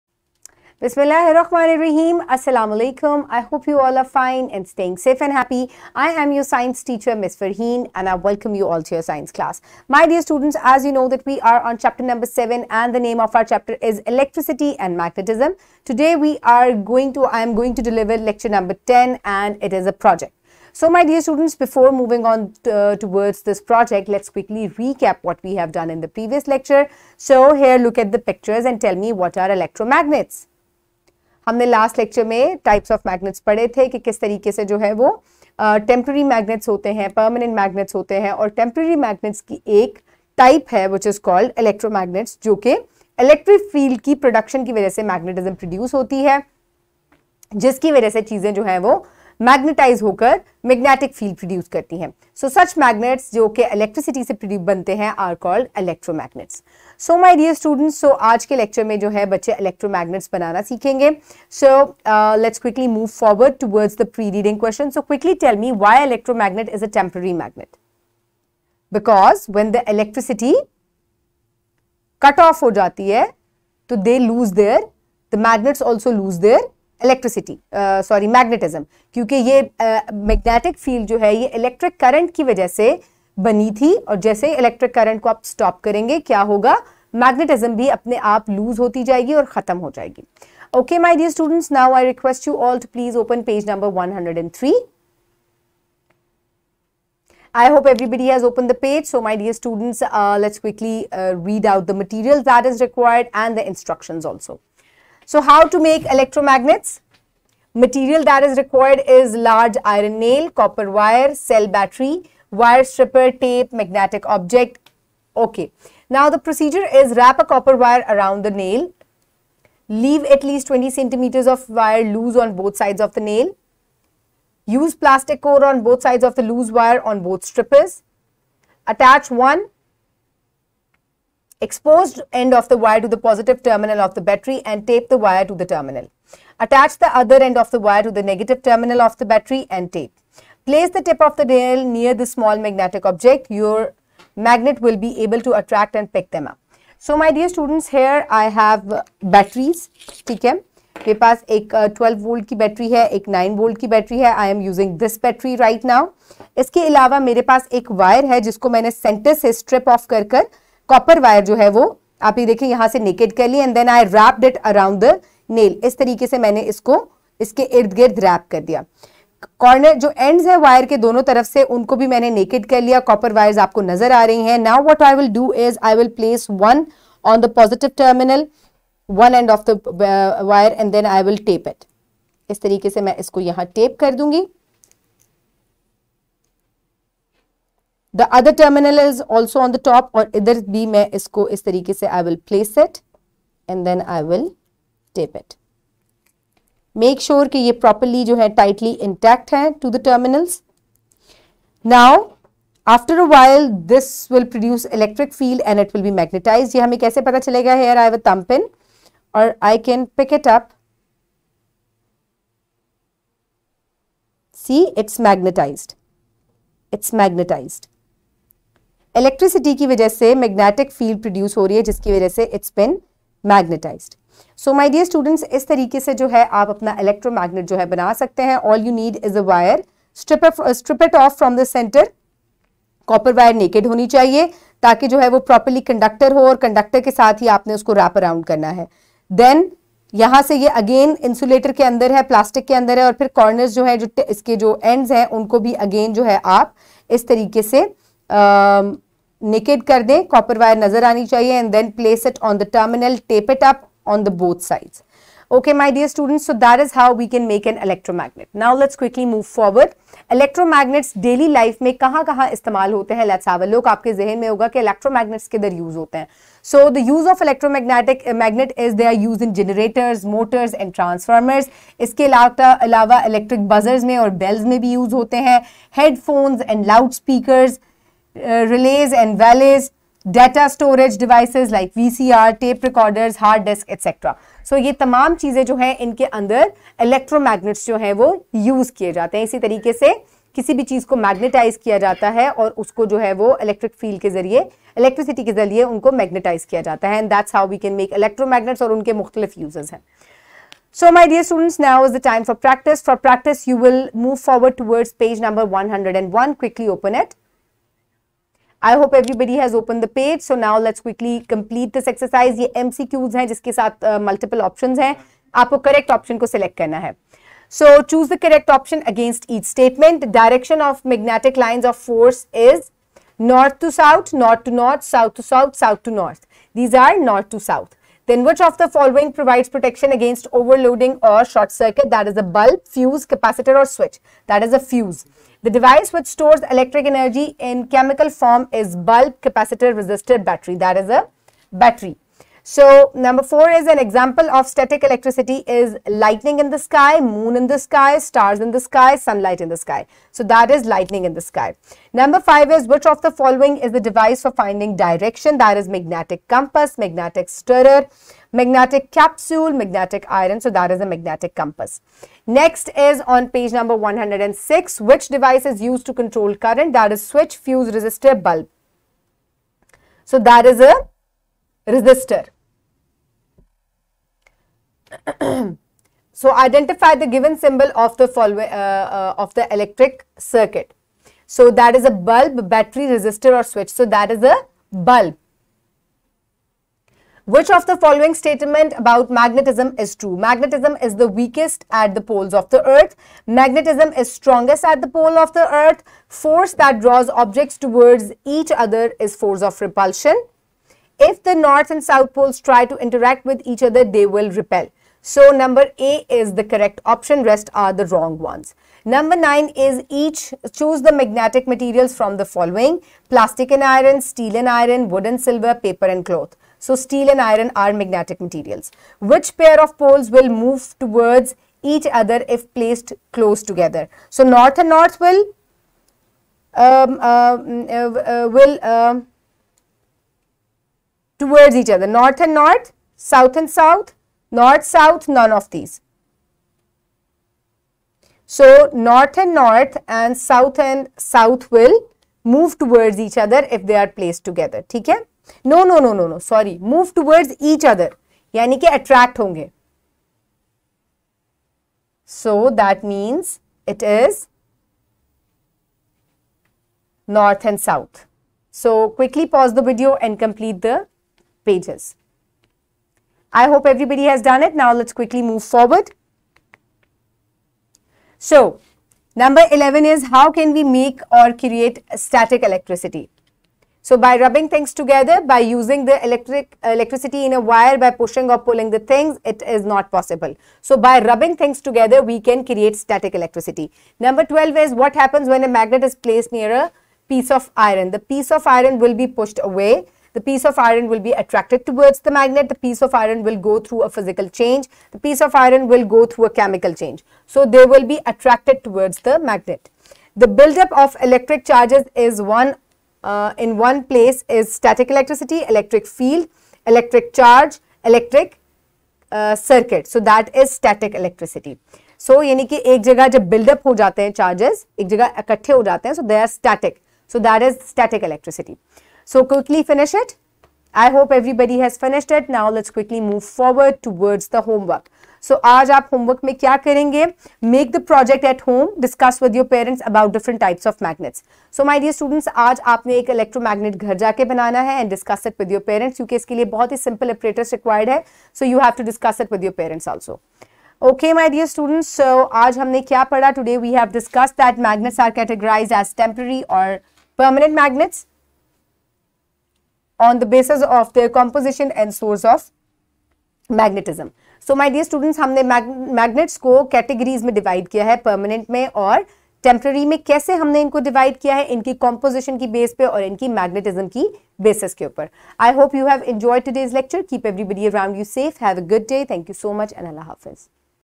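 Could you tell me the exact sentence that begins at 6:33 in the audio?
Magnetism is strongest at the pole of the earth.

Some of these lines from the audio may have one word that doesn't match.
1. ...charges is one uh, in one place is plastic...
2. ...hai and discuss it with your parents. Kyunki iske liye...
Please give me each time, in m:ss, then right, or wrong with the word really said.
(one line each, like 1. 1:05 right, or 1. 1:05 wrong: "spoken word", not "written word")
1. 8:21 wrong: "static", not "plastic"
2. 8:54 right.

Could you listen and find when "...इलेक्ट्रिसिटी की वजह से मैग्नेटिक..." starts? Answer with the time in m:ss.
3:39.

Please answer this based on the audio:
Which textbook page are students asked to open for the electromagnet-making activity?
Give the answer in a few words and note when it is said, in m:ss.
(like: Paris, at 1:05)
103, at 1:34.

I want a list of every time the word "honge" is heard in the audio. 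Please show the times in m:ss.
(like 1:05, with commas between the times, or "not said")
7:29.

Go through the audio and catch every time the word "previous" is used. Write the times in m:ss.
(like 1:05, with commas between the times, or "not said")
0:26.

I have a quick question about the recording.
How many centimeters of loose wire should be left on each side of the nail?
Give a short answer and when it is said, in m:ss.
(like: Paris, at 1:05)
20 centimeters, at 2:00.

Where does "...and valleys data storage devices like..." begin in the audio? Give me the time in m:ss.
4:39.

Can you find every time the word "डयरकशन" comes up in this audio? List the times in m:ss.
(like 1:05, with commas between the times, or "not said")
5:20.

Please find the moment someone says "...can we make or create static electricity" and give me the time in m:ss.
7:50.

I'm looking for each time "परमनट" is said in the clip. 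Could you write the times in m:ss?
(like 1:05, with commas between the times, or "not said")
0:37, 9:18.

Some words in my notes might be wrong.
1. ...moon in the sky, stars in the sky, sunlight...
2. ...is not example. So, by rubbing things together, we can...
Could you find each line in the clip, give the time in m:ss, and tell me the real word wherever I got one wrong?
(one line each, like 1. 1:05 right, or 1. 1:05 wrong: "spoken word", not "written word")
1. 5:47 right
2. 7:59 wrong: "possible", not "example".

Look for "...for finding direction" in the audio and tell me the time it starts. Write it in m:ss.
5:54.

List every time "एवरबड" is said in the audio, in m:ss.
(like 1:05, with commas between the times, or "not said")
5:09, 9:27.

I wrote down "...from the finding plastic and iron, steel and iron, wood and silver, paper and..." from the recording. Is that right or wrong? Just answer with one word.
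wrong.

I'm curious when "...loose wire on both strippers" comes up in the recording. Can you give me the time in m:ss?
2:06.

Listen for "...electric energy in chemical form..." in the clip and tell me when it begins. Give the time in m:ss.
5:36.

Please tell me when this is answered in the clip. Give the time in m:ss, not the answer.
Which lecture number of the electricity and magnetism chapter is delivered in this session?
0:18.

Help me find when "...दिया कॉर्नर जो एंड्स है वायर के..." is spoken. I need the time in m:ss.
2:48.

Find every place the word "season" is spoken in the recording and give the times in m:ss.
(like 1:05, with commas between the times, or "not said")
not said.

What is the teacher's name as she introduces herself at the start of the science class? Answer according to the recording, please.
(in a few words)
Ms. Farheen.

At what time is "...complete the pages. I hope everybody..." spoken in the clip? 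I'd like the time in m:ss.
7:40.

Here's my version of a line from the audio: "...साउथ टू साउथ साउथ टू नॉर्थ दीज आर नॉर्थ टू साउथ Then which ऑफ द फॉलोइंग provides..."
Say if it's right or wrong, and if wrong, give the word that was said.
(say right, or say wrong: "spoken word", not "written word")
right.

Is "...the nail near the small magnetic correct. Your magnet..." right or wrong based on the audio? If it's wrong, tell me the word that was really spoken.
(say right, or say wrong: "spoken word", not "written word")
wrong: "object", not "correct".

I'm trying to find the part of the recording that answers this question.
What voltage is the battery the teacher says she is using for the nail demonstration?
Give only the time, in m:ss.
2:33.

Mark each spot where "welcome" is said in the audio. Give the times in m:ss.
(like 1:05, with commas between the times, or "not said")
0:08.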